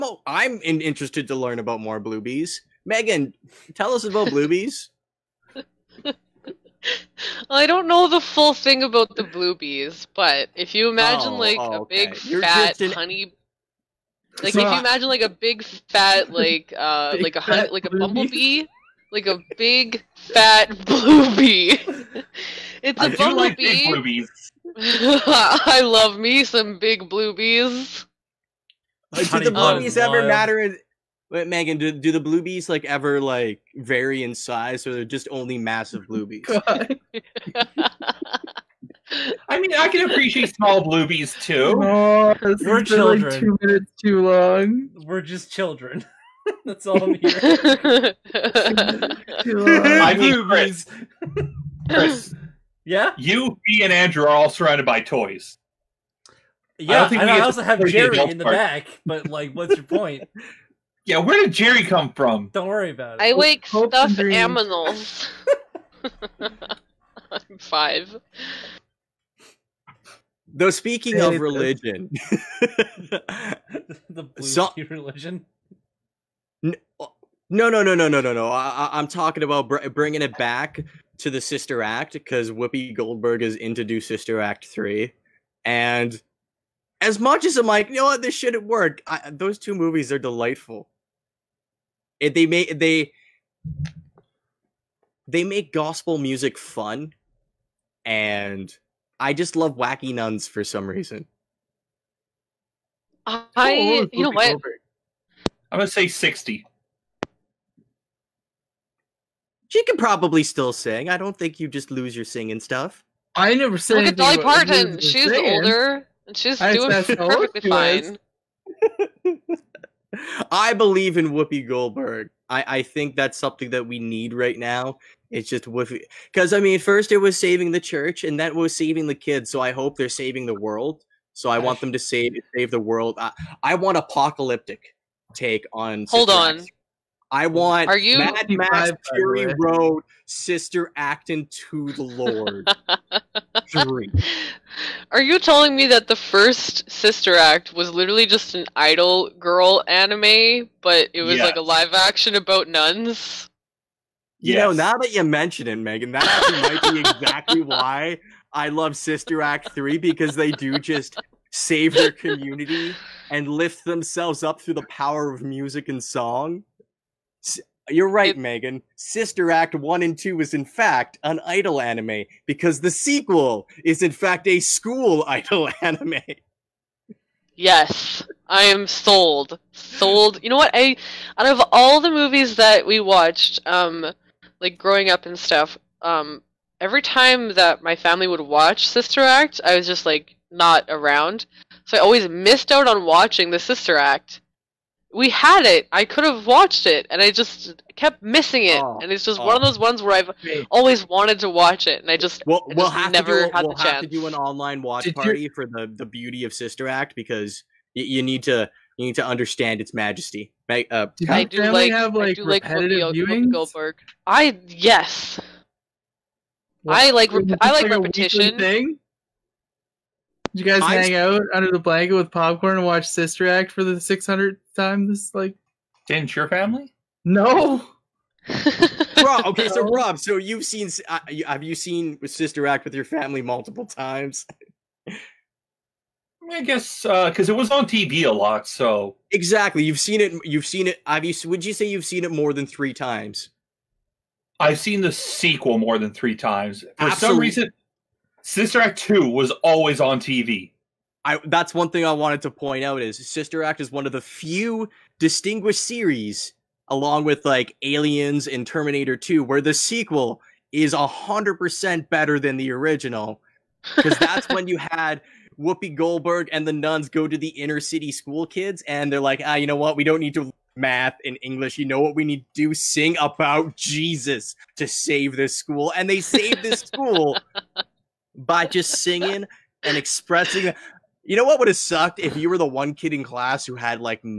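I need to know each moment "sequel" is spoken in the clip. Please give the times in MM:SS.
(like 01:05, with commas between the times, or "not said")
02:52, 04:05, 04:19.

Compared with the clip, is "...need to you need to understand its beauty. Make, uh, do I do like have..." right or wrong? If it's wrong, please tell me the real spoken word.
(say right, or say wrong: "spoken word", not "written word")
wrong: "majesty", not "beauty".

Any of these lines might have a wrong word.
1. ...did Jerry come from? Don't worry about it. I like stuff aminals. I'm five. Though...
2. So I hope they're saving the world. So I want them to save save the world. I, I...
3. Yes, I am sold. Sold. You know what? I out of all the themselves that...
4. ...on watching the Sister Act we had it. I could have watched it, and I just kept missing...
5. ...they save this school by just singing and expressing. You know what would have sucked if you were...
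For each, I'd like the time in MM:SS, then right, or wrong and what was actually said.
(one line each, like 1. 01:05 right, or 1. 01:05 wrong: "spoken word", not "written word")
1. 01:01 right
2. 02:09 right
3. 02:57 wrong: "movies", not "themselves"
4. 03:12 right
5. 04:36 right.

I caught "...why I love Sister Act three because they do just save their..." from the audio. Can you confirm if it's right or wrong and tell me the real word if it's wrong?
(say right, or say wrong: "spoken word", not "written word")
right.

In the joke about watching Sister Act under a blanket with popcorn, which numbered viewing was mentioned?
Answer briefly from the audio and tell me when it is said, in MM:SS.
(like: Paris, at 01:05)
600th, at 03:43.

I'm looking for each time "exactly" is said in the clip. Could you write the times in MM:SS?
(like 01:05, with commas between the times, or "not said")
02:37, 03:59.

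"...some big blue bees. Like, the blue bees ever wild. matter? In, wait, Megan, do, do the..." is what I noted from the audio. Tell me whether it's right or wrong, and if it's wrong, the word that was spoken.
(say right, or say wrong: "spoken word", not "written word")
right.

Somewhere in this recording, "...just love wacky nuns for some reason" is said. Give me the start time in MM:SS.
01:39.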